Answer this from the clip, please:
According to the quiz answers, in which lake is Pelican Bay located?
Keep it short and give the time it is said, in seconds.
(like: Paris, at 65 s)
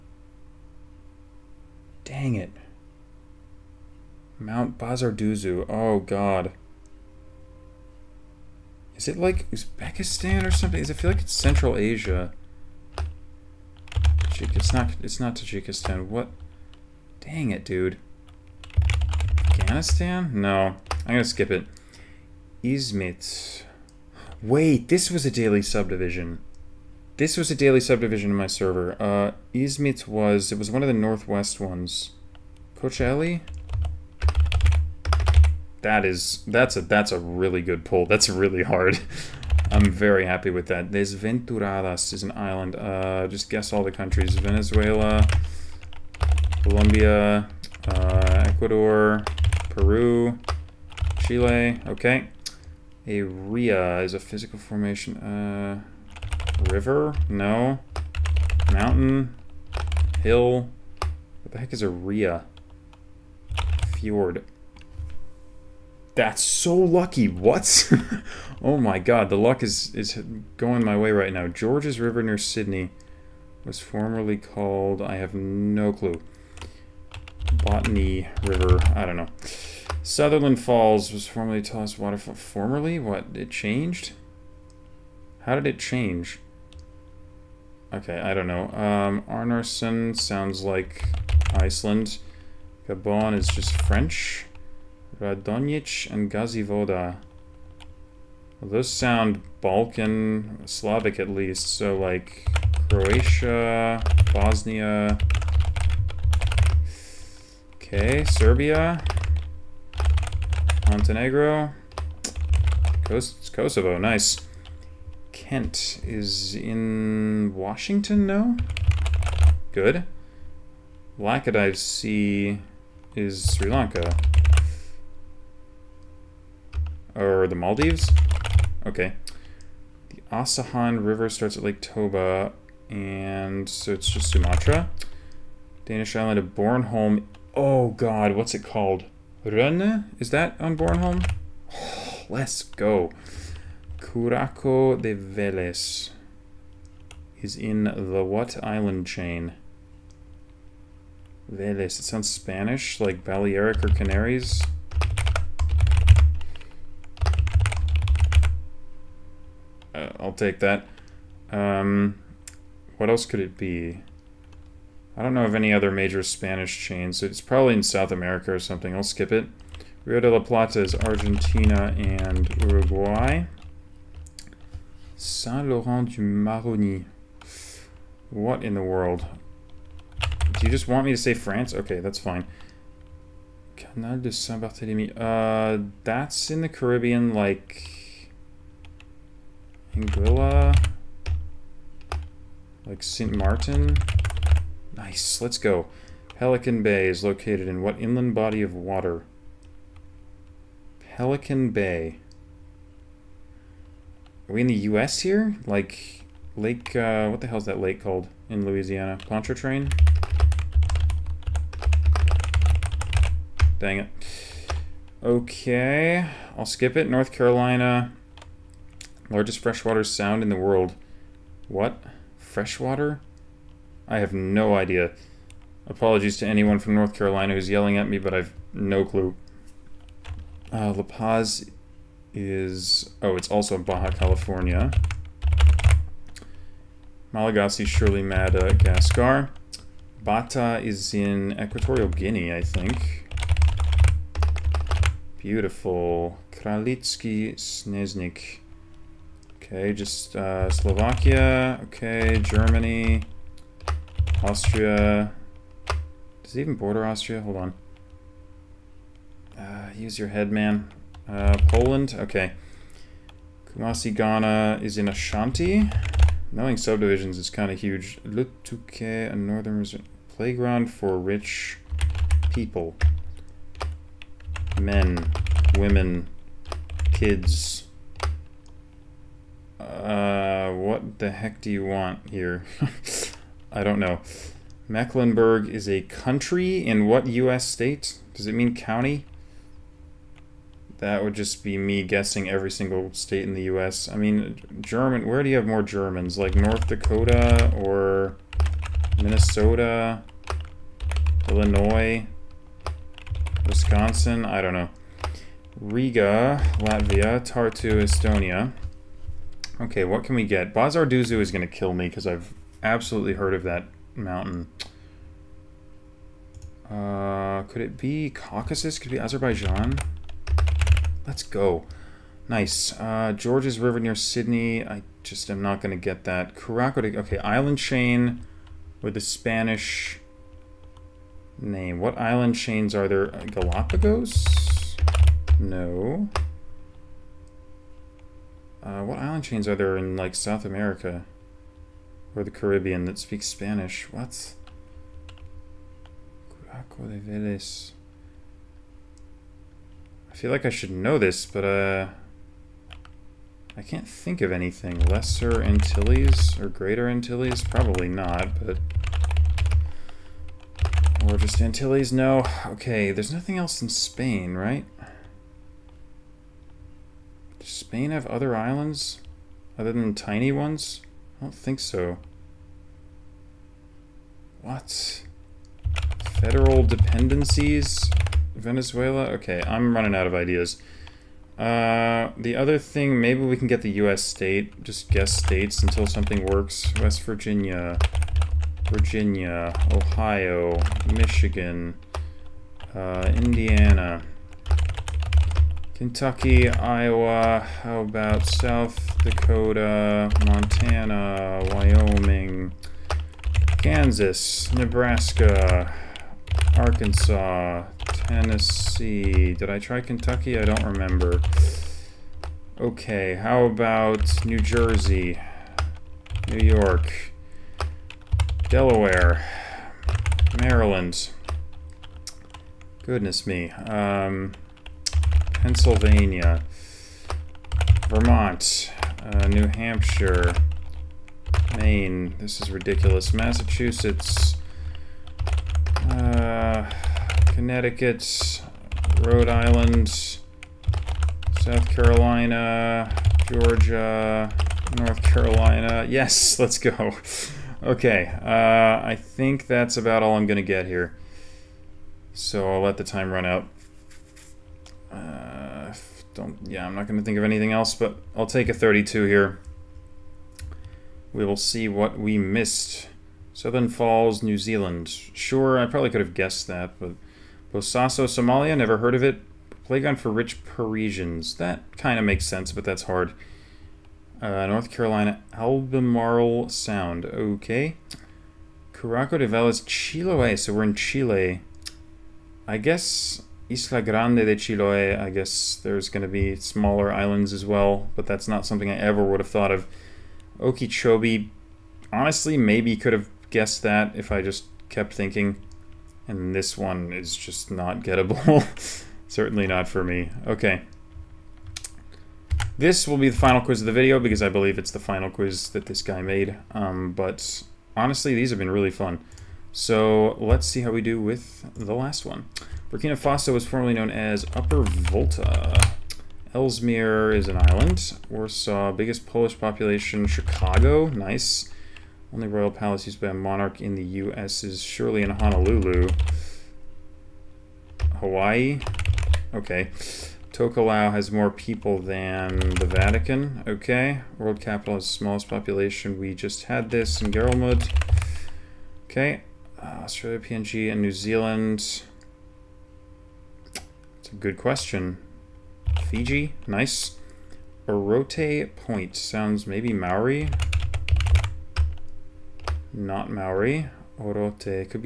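Okeechobee, at 490 s.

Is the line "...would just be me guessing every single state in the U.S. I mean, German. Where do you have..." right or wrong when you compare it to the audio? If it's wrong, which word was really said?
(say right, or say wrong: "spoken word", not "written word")
right.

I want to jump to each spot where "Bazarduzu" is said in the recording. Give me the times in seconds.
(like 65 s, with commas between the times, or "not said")
4 s, 310 s.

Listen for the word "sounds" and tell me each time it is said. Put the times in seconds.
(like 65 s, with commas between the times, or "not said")
90 s, 98 s, 152 s, 220 s, 476 s, 549 s.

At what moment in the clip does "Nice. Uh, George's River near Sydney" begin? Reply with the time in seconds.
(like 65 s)
322 s.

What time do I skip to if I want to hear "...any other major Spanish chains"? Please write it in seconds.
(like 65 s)
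165 s.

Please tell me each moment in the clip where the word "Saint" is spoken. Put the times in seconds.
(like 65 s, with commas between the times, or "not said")
175 s, 184 s.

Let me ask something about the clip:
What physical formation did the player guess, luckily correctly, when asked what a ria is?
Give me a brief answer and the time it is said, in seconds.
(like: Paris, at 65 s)
Fjord, at 63 s.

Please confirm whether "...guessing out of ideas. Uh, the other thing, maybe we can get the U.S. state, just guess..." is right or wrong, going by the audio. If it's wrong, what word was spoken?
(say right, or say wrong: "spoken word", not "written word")
wrong: "running", not "guessing".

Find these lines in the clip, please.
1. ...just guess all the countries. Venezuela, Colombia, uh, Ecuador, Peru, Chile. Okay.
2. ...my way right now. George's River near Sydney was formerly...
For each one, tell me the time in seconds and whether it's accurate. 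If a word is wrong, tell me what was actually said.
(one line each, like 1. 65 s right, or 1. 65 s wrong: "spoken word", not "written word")
1. 43 s right
2. 70 s right.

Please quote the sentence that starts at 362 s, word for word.
Okay, there's nothing else in Spain, right?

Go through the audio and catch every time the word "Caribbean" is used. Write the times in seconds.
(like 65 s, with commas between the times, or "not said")
186 s, 342 s.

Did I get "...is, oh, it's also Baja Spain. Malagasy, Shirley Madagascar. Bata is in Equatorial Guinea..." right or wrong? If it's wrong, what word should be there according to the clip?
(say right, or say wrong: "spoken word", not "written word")
wrong: "California", not "Spain".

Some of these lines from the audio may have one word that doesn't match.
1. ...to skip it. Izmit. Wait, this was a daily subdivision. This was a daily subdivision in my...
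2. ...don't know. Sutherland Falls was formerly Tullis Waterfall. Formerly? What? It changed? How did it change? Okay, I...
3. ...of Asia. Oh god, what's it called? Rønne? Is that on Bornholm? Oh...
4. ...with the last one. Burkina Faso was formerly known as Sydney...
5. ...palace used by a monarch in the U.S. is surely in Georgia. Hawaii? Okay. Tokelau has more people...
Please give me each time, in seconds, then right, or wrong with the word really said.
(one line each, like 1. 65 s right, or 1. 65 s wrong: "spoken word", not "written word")
1. 21 s right
2. 79 s right
3. 136 s wrong: "Bornholm", not "Asia"
4. 511 s wrong: "Upper", not "Sydney"
5. 522 s wrong: "Honolulu", not "Georgia".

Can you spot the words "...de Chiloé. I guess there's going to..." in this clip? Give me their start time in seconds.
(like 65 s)
484 s.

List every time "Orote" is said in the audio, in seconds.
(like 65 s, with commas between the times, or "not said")
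547 s, 554 s.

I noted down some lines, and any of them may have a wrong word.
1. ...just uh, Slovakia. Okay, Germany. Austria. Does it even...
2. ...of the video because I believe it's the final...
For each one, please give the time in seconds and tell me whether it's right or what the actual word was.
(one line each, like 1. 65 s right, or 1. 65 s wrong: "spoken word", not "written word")
1. 249 s right
2. 503 s right.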